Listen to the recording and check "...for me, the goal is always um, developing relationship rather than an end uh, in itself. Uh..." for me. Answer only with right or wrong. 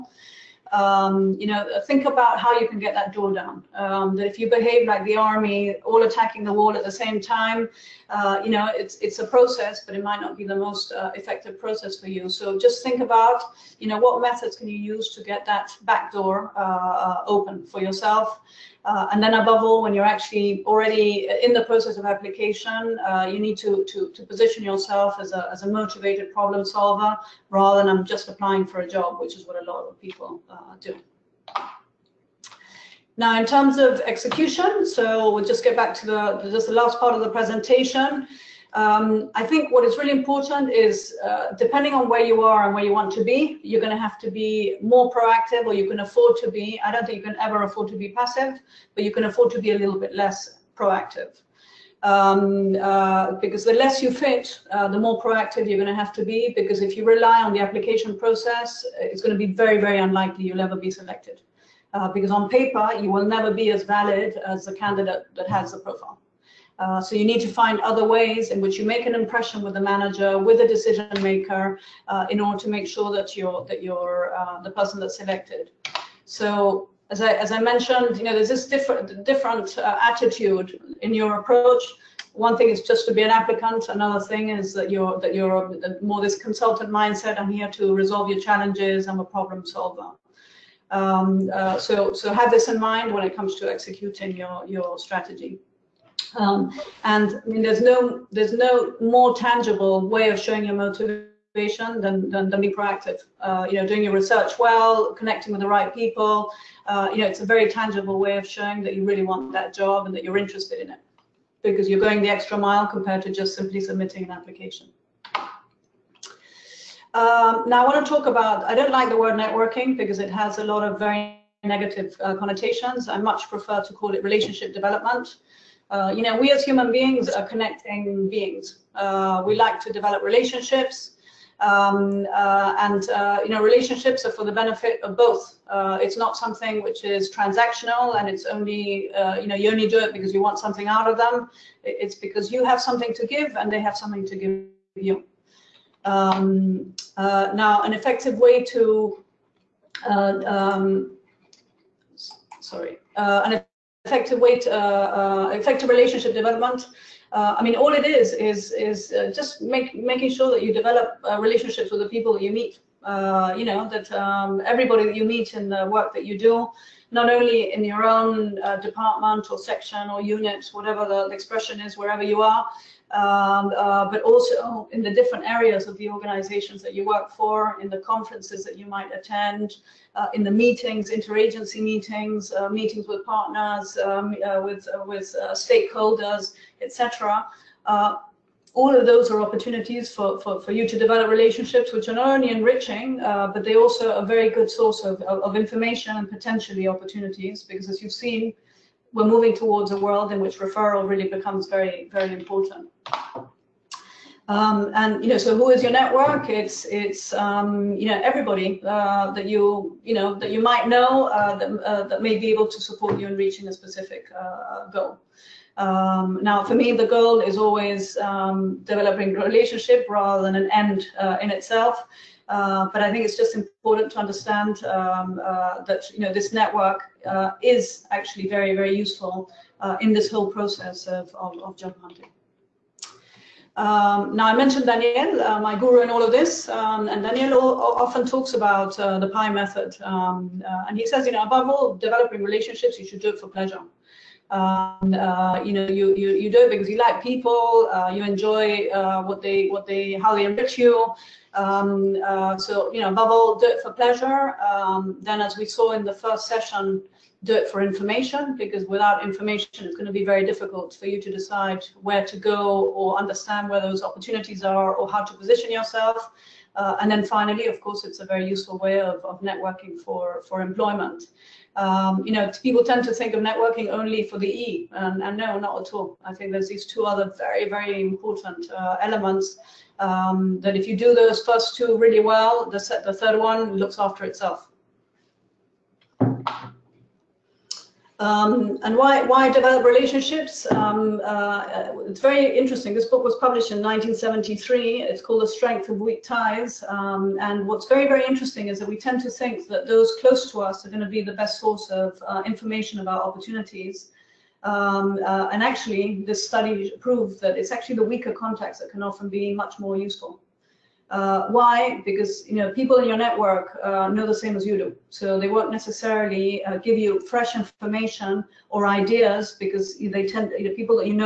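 right.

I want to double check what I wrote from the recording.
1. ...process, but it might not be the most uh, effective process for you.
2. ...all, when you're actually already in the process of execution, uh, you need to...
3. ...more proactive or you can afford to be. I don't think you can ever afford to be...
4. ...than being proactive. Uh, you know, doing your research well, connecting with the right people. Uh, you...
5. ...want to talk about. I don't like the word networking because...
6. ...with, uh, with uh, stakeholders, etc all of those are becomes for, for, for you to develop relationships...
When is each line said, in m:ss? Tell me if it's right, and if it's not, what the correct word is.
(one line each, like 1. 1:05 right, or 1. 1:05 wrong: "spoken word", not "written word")
1. 0:09 right
2. 0:19 wrong: "application", not "execution"
3. 0:44 right
4. 1:42 right
5. 1:57 right
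6. 3:04 wrong: "opportunities", not "becomes".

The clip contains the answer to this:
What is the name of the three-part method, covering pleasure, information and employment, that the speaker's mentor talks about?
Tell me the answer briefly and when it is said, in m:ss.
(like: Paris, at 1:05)
PIE method, at 3:59.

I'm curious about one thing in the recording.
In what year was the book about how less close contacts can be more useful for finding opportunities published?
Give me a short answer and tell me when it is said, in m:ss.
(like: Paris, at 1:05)
1973, at 4:53.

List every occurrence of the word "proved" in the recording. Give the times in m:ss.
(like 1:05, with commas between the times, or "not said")
5:06.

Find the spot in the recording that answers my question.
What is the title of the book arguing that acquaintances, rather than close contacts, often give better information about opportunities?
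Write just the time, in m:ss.
4:55.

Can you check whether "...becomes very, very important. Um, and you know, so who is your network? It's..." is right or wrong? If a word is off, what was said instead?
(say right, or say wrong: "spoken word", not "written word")
right.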